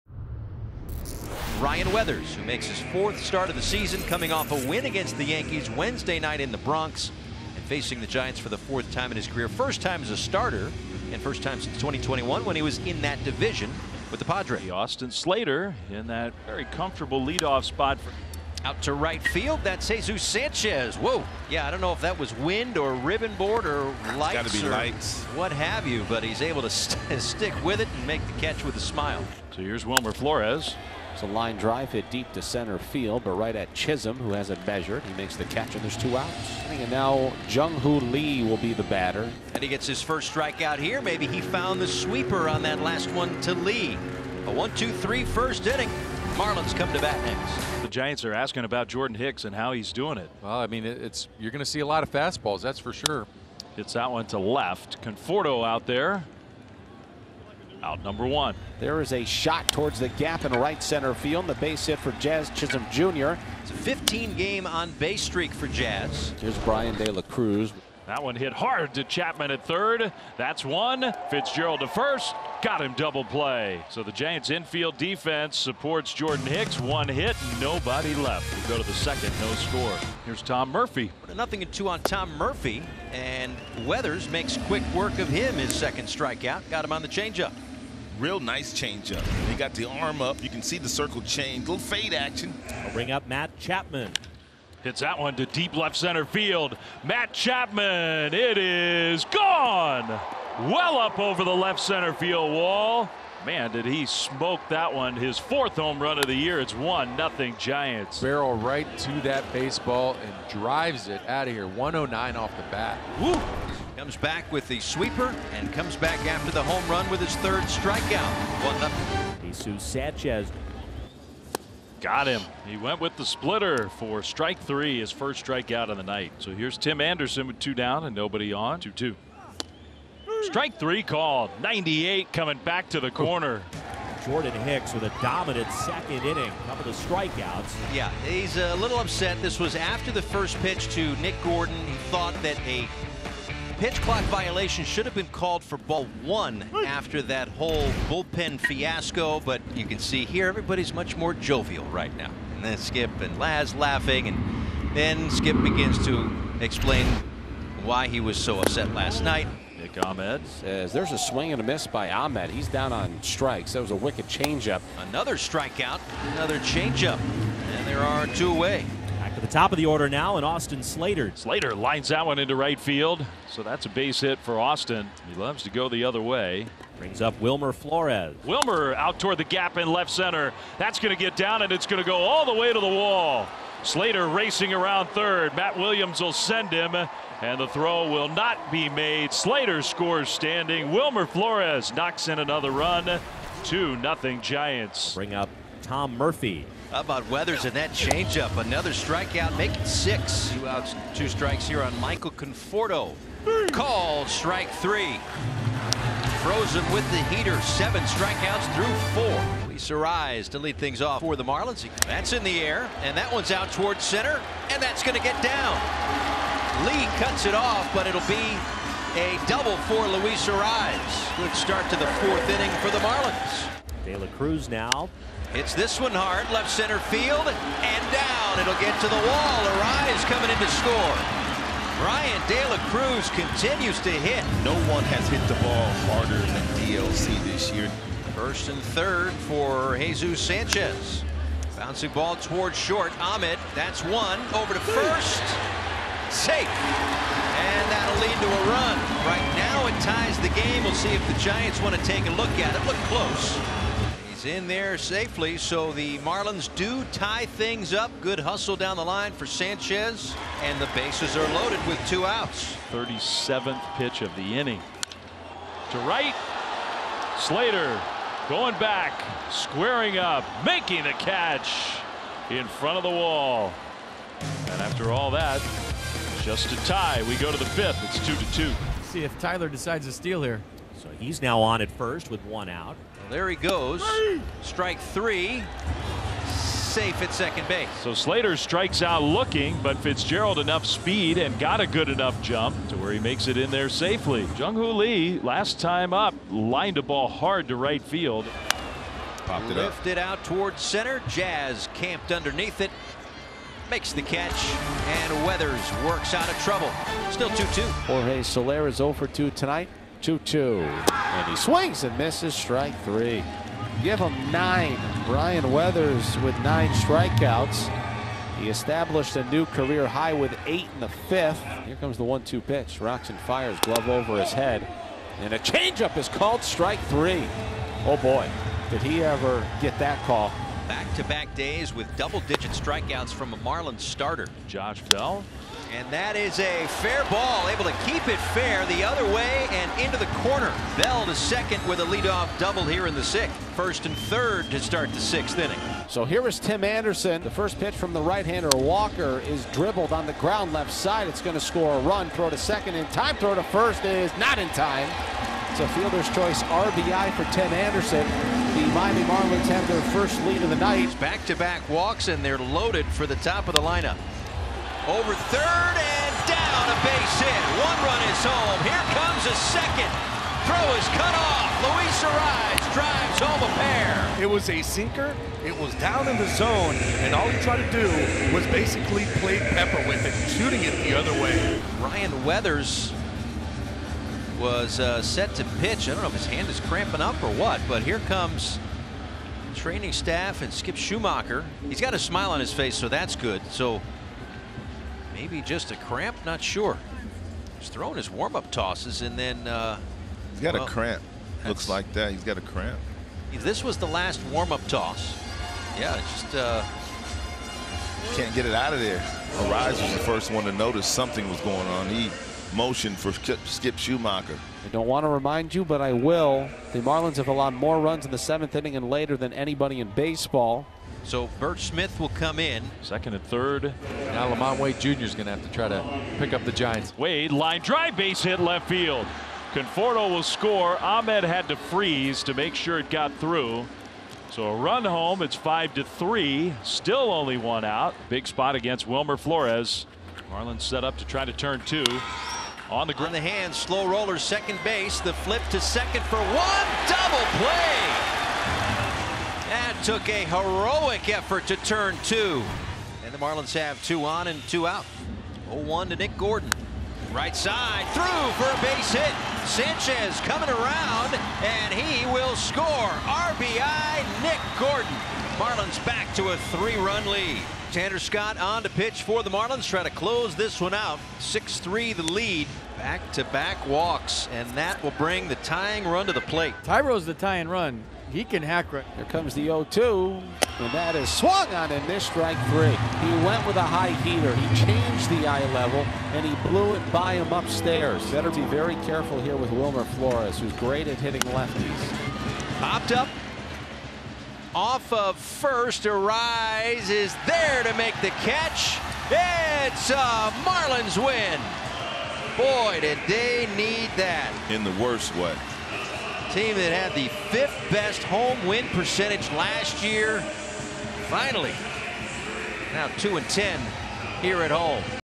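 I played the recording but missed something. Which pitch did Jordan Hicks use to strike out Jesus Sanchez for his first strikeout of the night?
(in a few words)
splitter.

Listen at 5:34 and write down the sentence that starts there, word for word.
Josh Bell and that is a fair ball, able to keep it fair the other way and into the corner.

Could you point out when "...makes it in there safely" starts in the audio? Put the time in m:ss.
4:53.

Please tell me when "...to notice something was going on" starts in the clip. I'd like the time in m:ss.
6:50.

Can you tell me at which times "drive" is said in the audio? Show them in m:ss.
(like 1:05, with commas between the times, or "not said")
0:31, 1:50, 6:12, 7:07.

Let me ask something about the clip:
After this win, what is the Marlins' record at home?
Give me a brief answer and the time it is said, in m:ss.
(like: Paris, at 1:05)
2 and 10, at 8:33.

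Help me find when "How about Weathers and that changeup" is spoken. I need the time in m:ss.
3:16.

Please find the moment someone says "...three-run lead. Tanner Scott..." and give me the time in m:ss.
7:46.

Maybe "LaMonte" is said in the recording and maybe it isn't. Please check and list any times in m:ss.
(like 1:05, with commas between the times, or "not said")
7:04.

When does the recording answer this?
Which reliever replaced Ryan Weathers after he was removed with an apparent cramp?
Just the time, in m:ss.
7:01.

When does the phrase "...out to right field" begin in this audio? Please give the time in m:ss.
0:18.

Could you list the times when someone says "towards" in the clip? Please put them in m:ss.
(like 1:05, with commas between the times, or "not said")
0:59, 2:59, 3:33, 4:02, 5:00.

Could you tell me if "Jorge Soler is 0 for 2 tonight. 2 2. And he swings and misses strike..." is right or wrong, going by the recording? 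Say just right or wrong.
right.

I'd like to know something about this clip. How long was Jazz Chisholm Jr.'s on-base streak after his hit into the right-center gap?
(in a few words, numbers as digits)
15 games.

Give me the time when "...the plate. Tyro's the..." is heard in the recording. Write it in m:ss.
7:56.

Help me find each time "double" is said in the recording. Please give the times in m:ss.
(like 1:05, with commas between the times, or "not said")
1:12, 3:39, 5:32, 5:42, 7:27.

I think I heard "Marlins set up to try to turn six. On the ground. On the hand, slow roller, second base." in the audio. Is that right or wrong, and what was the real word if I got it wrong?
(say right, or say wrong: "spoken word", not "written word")
wrong: "two", not "six".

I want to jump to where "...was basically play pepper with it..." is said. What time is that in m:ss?
6:18.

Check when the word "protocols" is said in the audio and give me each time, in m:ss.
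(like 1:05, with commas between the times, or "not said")
not said.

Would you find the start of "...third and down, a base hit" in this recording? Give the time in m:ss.
6:05.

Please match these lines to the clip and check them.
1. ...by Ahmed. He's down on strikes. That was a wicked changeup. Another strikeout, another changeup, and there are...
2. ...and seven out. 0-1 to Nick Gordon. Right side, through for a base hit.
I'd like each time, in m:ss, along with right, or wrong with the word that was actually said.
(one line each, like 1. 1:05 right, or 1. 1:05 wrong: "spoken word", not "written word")
1. 2:41 right
2. 7:34 wrong: "two", not "seven".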